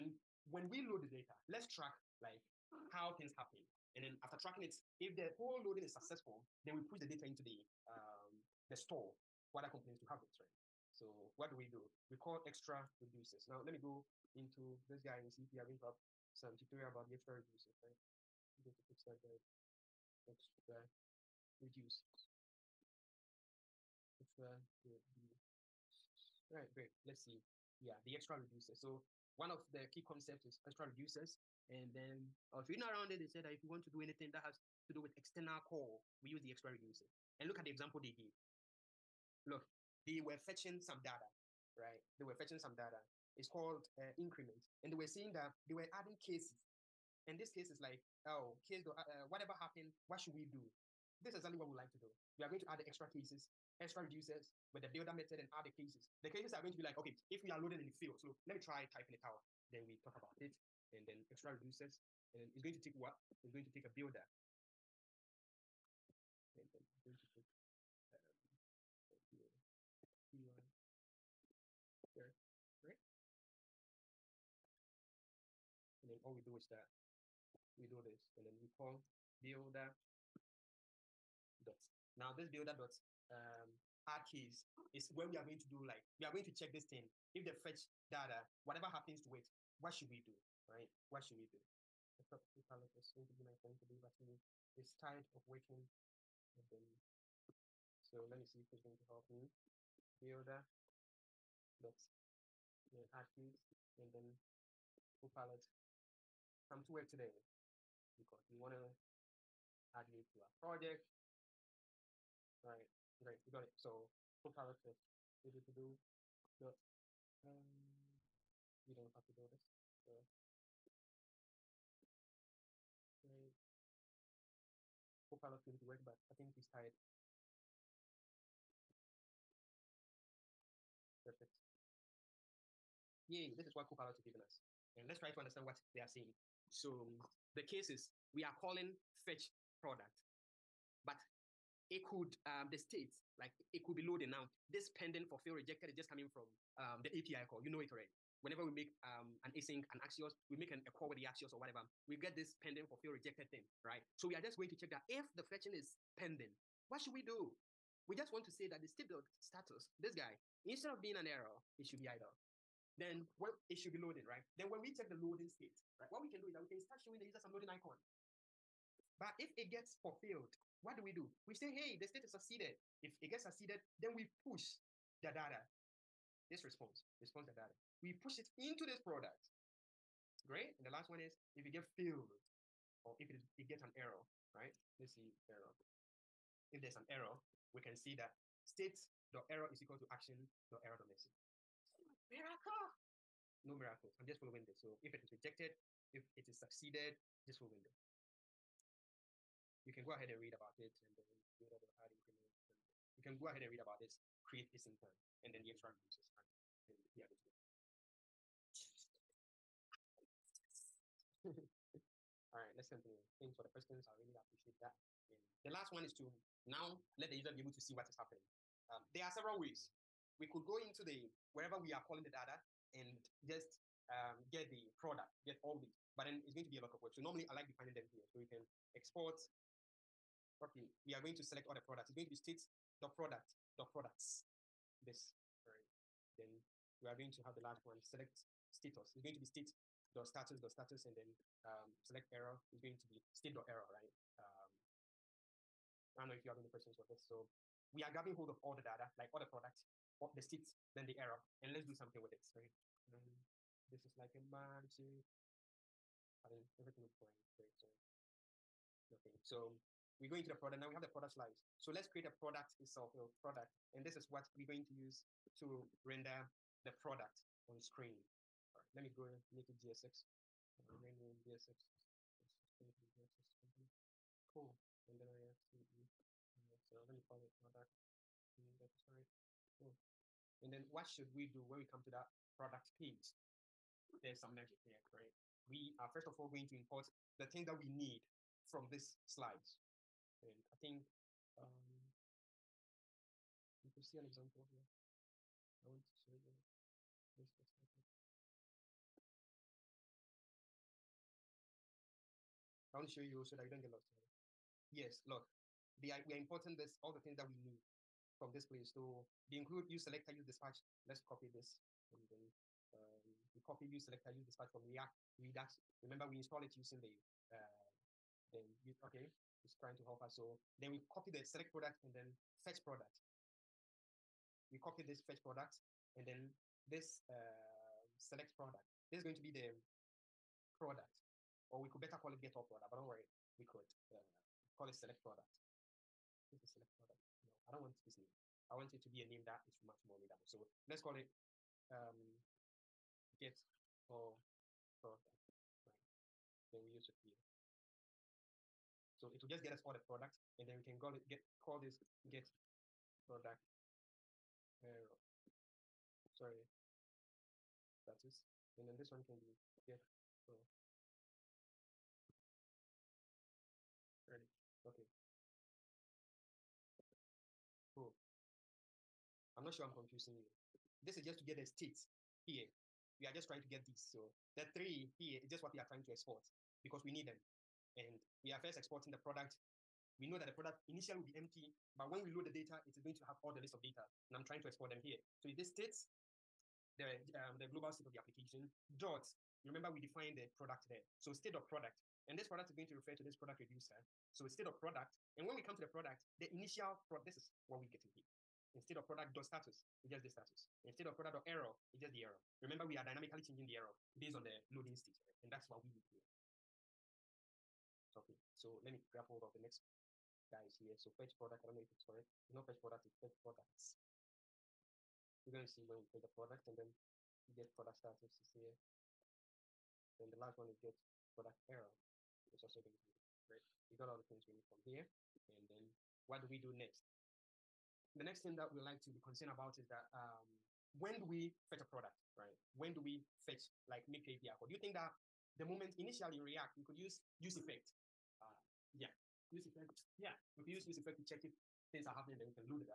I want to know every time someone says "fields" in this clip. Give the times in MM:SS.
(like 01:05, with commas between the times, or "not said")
00:57, 01:43.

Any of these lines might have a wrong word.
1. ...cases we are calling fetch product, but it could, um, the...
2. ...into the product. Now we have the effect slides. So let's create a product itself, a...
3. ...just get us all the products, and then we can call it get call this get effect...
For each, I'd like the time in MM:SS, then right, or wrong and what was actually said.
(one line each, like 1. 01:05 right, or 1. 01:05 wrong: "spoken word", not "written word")
1. 02:17 right
2. 04:20 wrong: "product", not "effect"
3. 05:49 wrong: "product", not "effect".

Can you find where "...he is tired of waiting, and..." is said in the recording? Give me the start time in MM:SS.
01:34.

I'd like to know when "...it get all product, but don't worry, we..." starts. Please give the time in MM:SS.
05:32.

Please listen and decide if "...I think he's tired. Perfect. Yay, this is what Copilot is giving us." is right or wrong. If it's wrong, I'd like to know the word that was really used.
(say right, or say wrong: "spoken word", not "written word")
right.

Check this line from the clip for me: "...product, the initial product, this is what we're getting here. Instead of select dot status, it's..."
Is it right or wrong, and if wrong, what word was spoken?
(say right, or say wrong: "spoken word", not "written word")
wrong: "product", not "select".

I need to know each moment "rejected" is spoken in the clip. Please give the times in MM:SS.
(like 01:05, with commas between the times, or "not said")
02:25, 02:33, 03:15.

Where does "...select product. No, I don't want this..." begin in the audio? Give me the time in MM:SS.
05:36.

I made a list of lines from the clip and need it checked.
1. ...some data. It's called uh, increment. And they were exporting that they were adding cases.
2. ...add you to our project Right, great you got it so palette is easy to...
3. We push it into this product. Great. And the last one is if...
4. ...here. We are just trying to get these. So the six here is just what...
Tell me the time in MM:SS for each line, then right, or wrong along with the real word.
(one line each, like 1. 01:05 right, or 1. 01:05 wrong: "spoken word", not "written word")
1. 00:42 wrong: "seeing", not "exporting"
2. 01:49 right
3. 02:58 right
4. 06:12 wrong: "three", not "six".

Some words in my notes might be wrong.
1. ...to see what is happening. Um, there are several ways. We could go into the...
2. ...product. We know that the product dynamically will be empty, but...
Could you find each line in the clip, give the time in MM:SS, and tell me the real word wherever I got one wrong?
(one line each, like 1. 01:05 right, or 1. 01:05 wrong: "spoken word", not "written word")
1. 03:37 right
2. 06:19 wrong: "initially", not "dynamically".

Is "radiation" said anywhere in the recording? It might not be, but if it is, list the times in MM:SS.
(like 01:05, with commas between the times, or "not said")
not said.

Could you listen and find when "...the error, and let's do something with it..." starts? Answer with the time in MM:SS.
04:11.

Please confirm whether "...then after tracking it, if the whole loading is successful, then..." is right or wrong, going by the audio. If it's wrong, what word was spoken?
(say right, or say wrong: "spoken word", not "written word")
right.